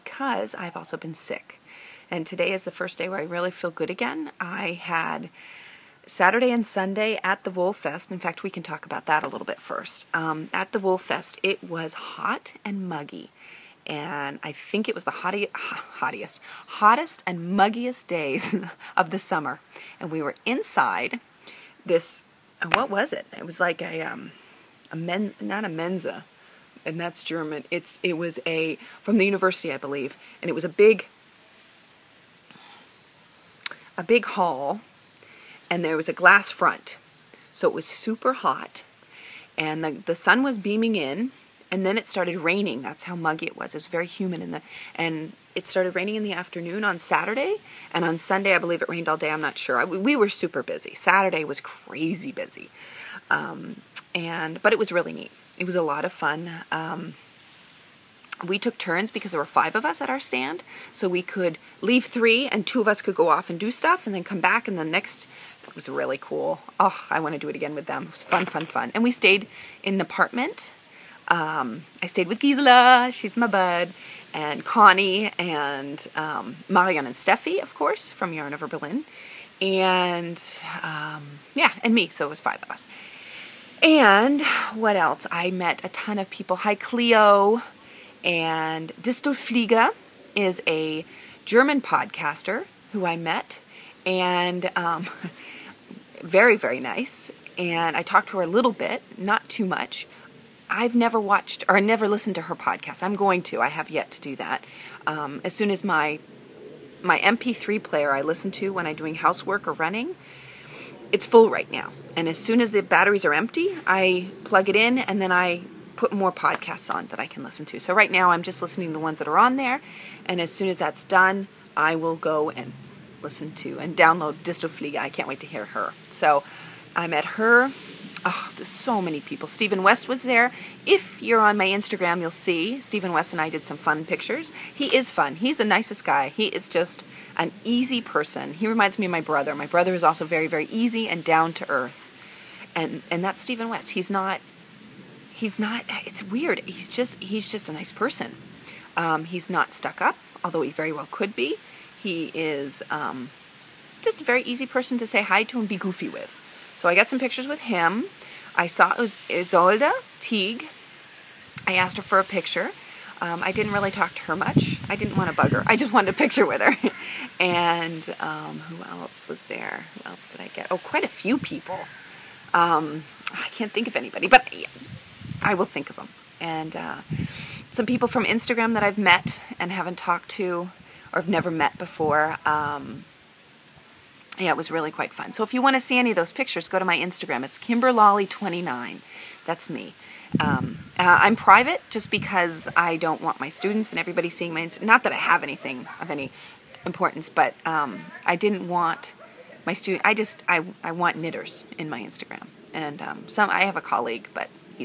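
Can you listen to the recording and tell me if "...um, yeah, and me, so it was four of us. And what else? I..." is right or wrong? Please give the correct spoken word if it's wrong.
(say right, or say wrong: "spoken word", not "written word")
wrong: "five", not "four".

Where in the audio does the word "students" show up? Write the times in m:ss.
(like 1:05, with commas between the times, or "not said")
3:13, 3:19.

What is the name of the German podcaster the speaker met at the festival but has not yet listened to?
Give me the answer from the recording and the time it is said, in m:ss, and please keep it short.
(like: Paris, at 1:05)
Distelflieger, at 1:29.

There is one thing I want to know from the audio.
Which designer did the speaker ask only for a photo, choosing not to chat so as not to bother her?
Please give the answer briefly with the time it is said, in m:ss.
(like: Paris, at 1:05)
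Ysolda Teague, at 2:39.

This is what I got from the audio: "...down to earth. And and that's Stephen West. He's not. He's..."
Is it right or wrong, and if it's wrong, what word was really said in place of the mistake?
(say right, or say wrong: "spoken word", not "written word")
right.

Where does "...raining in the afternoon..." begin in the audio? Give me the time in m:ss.
0:45.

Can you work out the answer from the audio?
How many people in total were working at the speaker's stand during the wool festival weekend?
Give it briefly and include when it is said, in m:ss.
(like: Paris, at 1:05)
5, at 0:59.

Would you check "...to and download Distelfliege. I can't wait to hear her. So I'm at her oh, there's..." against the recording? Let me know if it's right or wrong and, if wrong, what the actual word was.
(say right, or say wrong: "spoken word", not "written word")
right.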